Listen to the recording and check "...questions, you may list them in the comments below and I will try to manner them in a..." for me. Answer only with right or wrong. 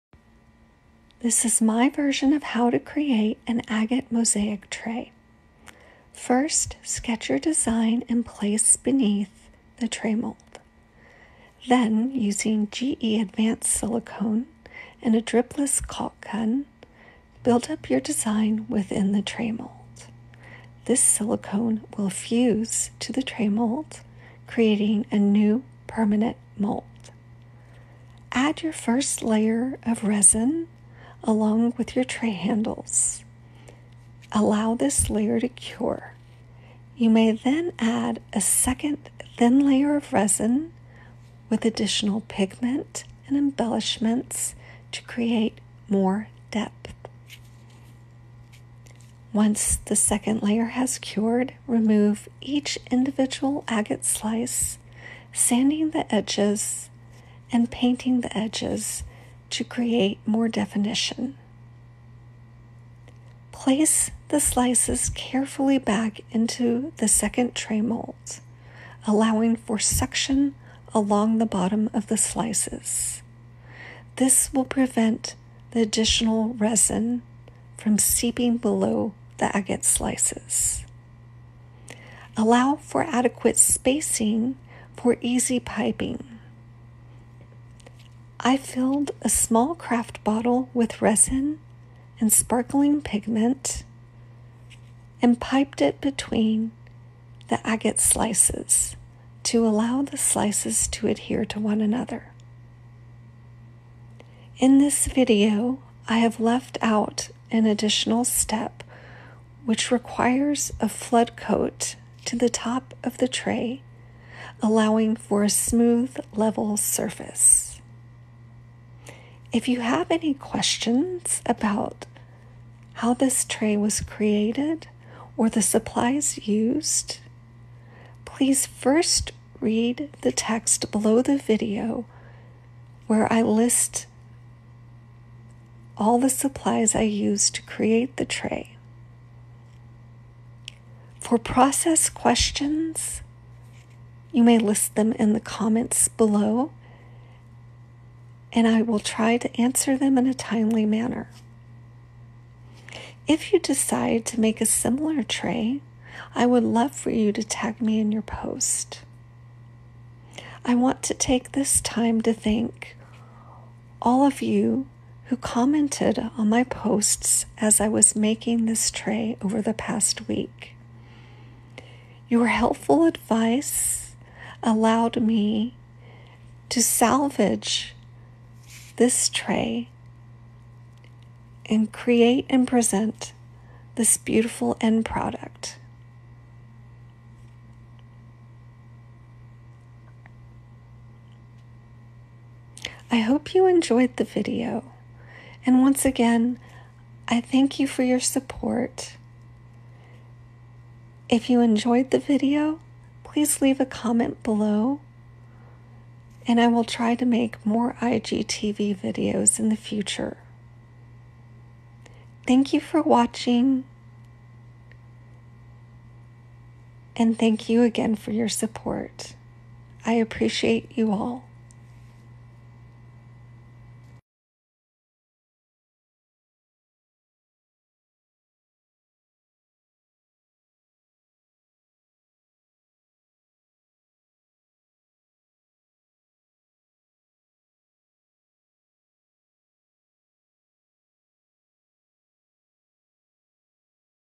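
wrong.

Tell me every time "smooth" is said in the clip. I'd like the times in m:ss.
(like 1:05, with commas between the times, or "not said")
1:55.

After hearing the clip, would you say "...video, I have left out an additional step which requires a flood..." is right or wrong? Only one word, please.
right.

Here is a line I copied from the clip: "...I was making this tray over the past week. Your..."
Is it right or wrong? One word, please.
right.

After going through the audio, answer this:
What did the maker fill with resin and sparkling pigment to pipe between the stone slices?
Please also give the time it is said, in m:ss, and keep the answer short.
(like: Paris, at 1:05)
A small craft bottle, at 1:29.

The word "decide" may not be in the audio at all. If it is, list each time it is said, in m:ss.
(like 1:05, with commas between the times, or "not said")
2:33.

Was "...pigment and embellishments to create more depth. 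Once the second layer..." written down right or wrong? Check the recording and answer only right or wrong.
right.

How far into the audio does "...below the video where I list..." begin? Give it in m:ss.
2:10.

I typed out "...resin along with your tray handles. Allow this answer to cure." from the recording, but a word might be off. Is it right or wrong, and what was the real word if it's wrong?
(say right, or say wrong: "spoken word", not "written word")
wrong: "layer", not "answer".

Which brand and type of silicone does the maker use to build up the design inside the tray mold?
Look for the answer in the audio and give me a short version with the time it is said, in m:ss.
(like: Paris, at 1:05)
GE Advanced Silicone, at 0:12.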